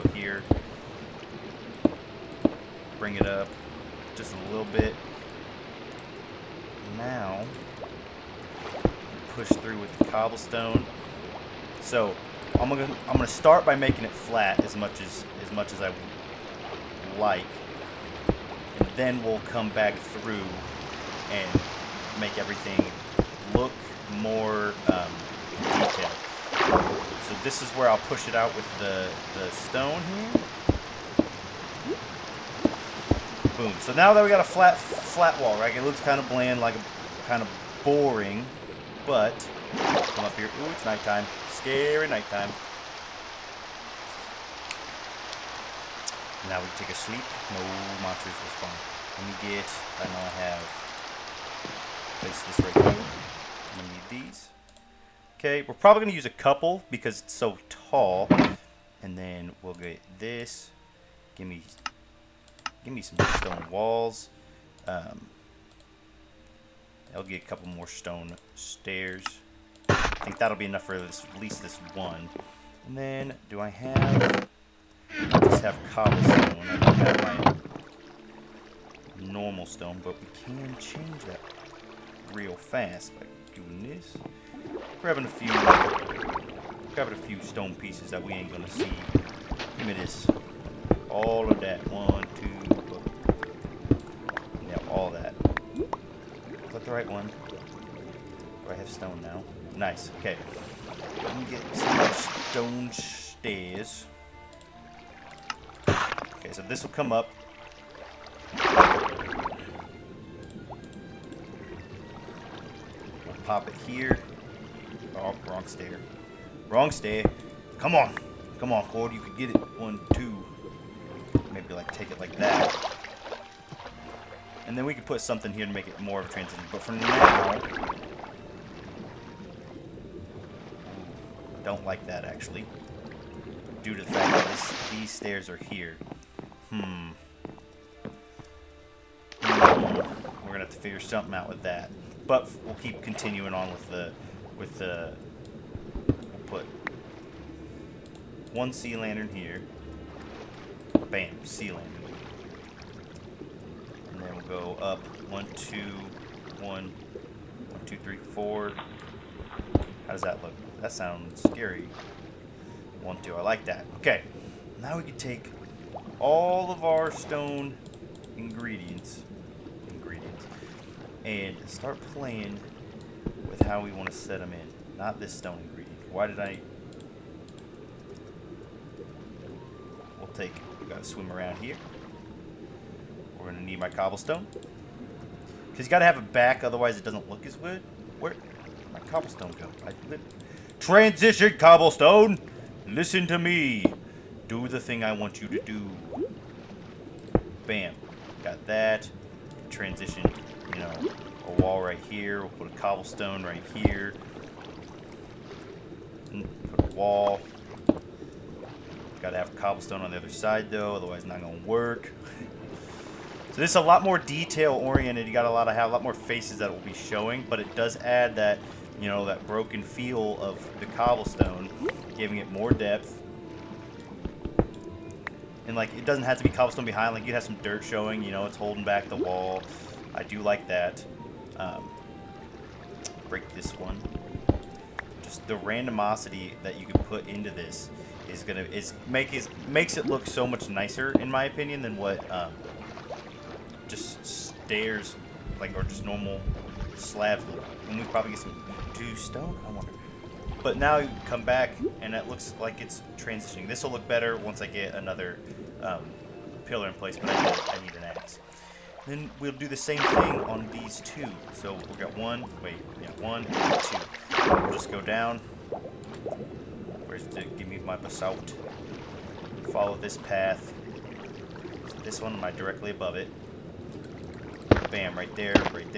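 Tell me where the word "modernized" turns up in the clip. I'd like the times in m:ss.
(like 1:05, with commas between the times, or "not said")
not said.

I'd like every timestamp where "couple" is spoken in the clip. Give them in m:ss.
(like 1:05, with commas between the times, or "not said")
0:56, 1:07.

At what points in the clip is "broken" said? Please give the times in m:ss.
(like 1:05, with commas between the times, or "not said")
3:39.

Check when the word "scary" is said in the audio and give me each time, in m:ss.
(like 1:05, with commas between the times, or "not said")
0:41, 2:41.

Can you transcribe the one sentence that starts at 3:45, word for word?
And like it doesn't have to be cobblestone behind, like you have some dirt showing, you know, it's holding back the wall.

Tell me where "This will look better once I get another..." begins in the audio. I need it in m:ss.
4:13.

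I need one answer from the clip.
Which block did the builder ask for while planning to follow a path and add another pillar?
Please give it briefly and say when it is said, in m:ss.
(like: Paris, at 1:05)
Basalt, at 4:27.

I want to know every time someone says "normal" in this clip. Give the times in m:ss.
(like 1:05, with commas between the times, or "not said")
1:19, 4:06.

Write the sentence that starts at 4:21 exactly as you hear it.
So we'll get one, wait, yeah, one, two.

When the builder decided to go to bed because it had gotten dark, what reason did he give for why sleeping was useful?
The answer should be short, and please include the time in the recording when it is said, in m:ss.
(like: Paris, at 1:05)
No monsters will spawn, at 0:47.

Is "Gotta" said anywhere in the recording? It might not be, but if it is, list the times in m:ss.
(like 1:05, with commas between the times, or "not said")
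3:29.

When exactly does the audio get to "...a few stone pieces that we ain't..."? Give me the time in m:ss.
1:27.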